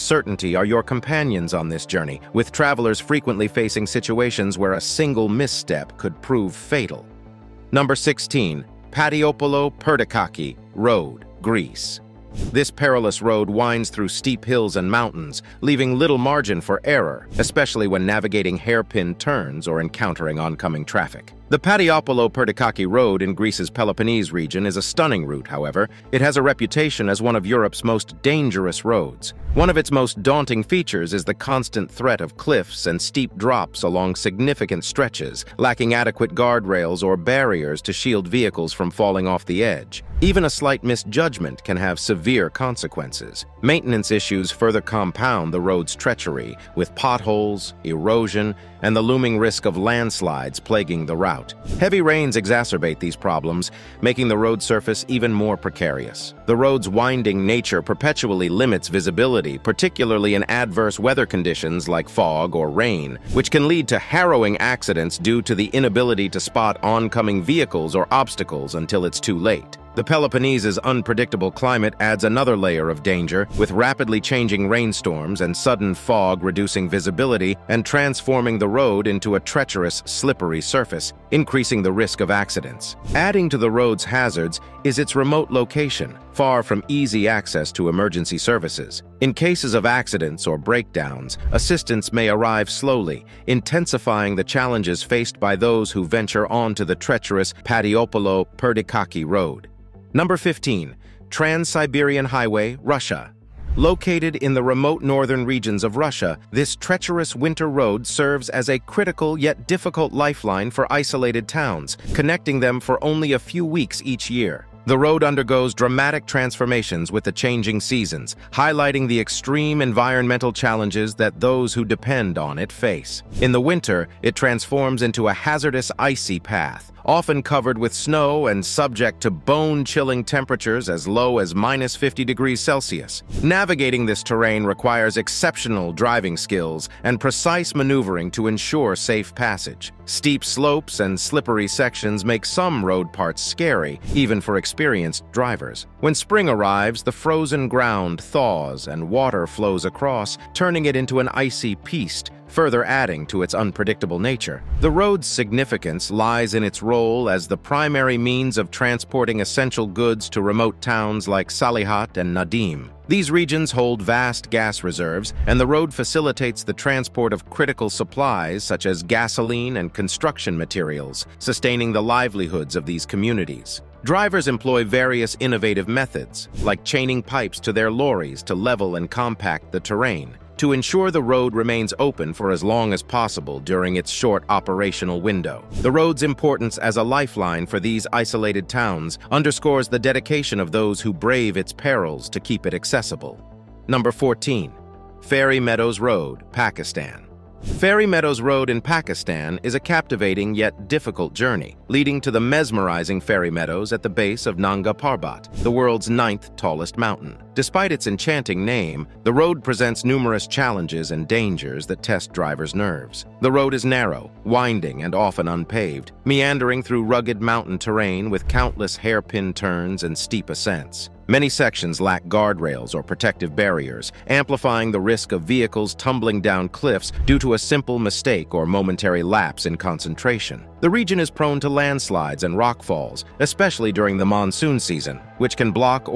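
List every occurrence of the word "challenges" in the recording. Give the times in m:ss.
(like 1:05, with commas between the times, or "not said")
1:34, 2:00, 3:30.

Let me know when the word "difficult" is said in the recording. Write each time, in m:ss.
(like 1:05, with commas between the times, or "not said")
1:49, 3:20.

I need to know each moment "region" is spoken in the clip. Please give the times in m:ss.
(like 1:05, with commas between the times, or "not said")
0:24, 1:45, 2:43, 3:50.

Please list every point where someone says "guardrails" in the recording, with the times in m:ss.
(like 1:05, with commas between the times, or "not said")
0:36, 3:42.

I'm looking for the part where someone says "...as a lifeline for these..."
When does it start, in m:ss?
3:06.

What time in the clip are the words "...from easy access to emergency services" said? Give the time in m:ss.
1:26.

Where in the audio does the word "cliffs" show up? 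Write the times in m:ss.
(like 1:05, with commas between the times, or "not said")
0:32, 3:46.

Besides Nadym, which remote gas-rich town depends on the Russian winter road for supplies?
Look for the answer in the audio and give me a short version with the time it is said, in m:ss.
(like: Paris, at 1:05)
Salekhard, at 2:41.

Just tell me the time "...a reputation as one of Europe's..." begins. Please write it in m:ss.
0:26.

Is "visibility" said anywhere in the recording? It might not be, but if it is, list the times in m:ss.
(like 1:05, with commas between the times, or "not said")
0:58, 1:16.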